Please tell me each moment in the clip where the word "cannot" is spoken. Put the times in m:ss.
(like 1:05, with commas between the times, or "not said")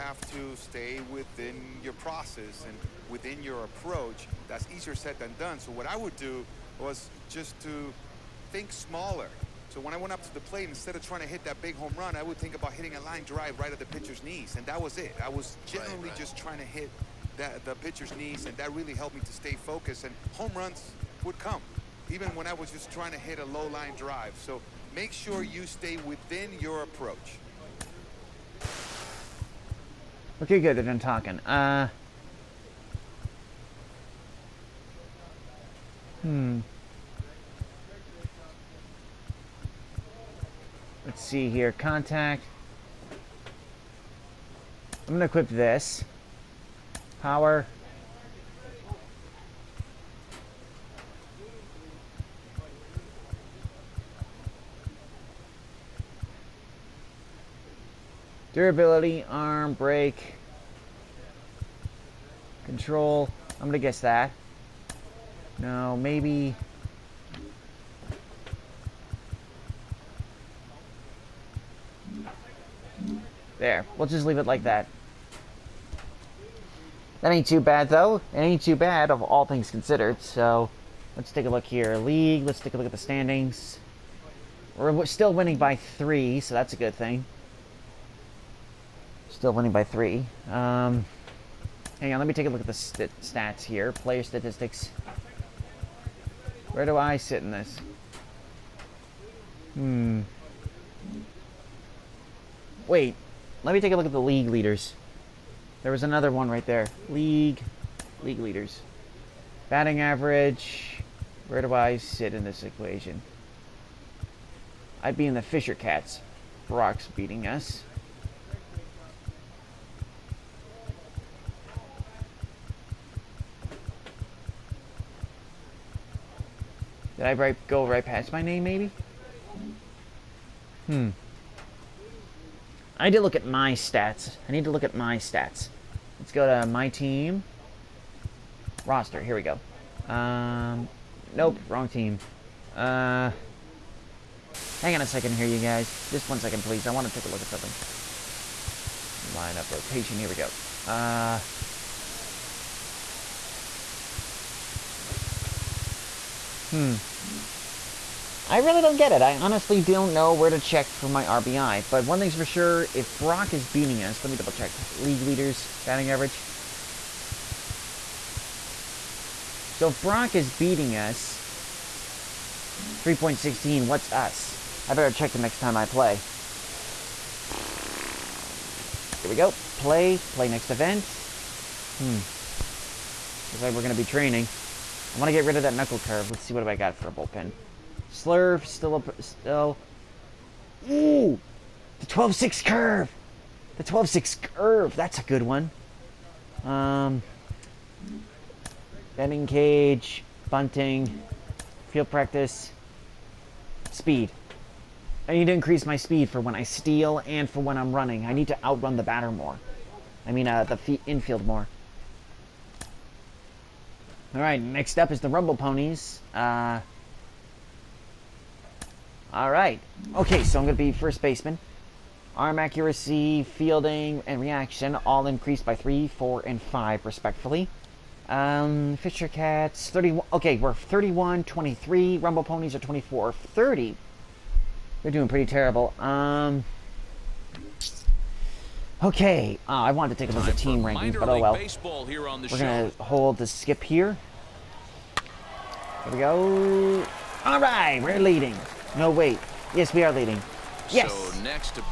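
not said.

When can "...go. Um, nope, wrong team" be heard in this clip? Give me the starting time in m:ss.
2:19.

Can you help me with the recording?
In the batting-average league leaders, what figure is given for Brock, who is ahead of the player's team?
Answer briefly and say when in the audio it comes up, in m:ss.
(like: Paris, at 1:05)
3.16, at 2:53.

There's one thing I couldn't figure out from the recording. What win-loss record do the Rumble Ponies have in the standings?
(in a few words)
24-30.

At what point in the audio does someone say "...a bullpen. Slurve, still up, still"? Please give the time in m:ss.
3:07.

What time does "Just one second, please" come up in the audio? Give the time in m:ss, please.
2:26.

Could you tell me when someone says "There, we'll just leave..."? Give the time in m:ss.
1:13.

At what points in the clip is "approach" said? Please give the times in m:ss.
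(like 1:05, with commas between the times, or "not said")
0:03, 0:26.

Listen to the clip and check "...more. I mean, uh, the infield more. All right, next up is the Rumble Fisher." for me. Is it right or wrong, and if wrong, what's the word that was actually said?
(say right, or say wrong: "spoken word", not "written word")
wrong: "Ponies", not "Fisher".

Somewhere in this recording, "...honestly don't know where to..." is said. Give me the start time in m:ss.
2:39.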